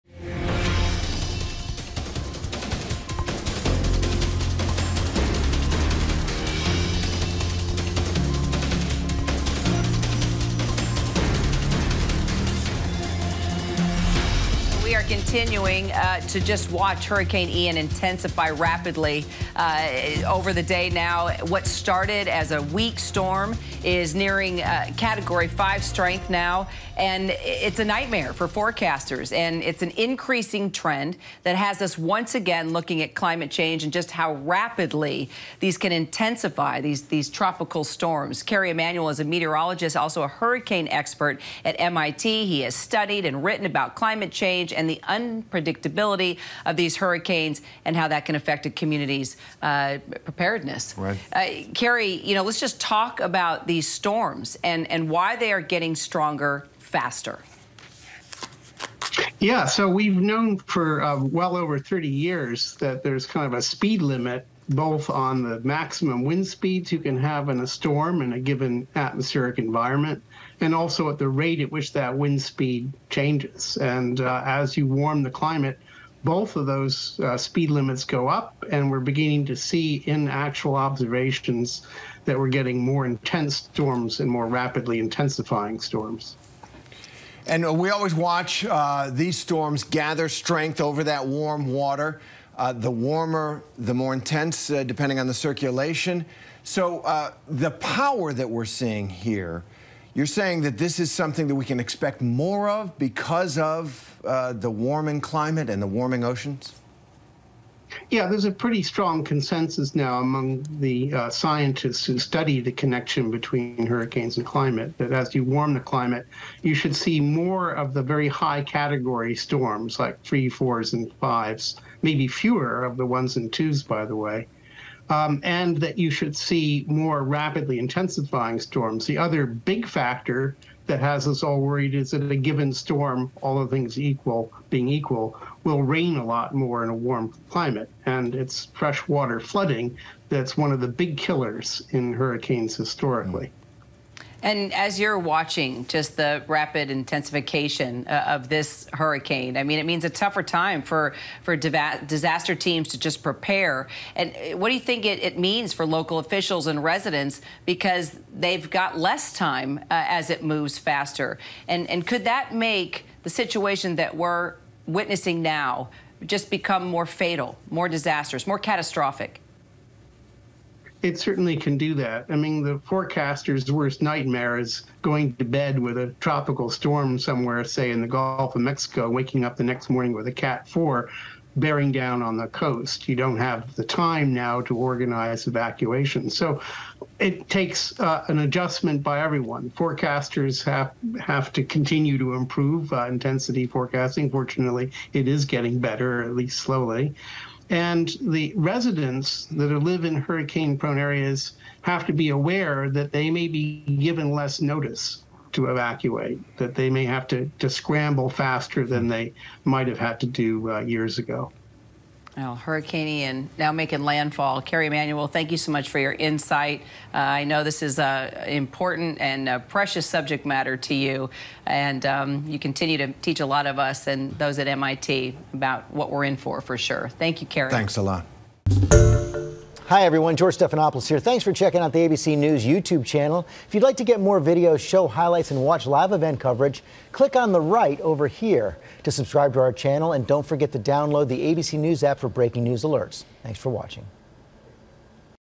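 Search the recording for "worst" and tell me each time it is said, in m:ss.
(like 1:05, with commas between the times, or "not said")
2:53.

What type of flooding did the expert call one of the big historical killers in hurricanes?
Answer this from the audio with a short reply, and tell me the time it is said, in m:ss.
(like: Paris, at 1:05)
freshwater flooding, at 2:18.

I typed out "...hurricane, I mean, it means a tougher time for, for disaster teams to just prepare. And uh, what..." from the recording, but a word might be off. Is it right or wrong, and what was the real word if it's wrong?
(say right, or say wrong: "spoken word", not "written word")
right.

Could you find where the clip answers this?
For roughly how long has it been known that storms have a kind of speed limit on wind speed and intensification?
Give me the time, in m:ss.
1:01.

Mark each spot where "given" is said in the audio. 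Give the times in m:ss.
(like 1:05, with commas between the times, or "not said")
1:08, 2:12, 3:23.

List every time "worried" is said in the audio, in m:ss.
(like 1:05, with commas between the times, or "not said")
2:11.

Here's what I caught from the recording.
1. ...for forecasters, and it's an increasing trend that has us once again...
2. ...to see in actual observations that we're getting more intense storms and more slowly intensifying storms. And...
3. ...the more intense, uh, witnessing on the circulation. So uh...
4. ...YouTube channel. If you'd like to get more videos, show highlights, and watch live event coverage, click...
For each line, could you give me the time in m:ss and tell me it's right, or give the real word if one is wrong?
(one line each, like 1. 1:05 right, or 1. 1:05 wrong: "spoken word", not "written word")
1. 0:28 right
2. 1:19 wrong: "rapidly", not "slowly"
3. 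1:33 wrong: "depending", not "witnessing"
4. 3:52 right.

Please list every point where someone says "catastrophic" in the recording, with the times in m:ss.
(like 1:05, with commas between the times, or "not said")
2:48.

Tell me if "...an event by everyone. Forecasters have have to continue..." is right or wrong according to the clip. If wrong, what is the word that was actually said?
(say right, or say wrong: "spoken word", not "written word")
wrong: "adjustment", not "event".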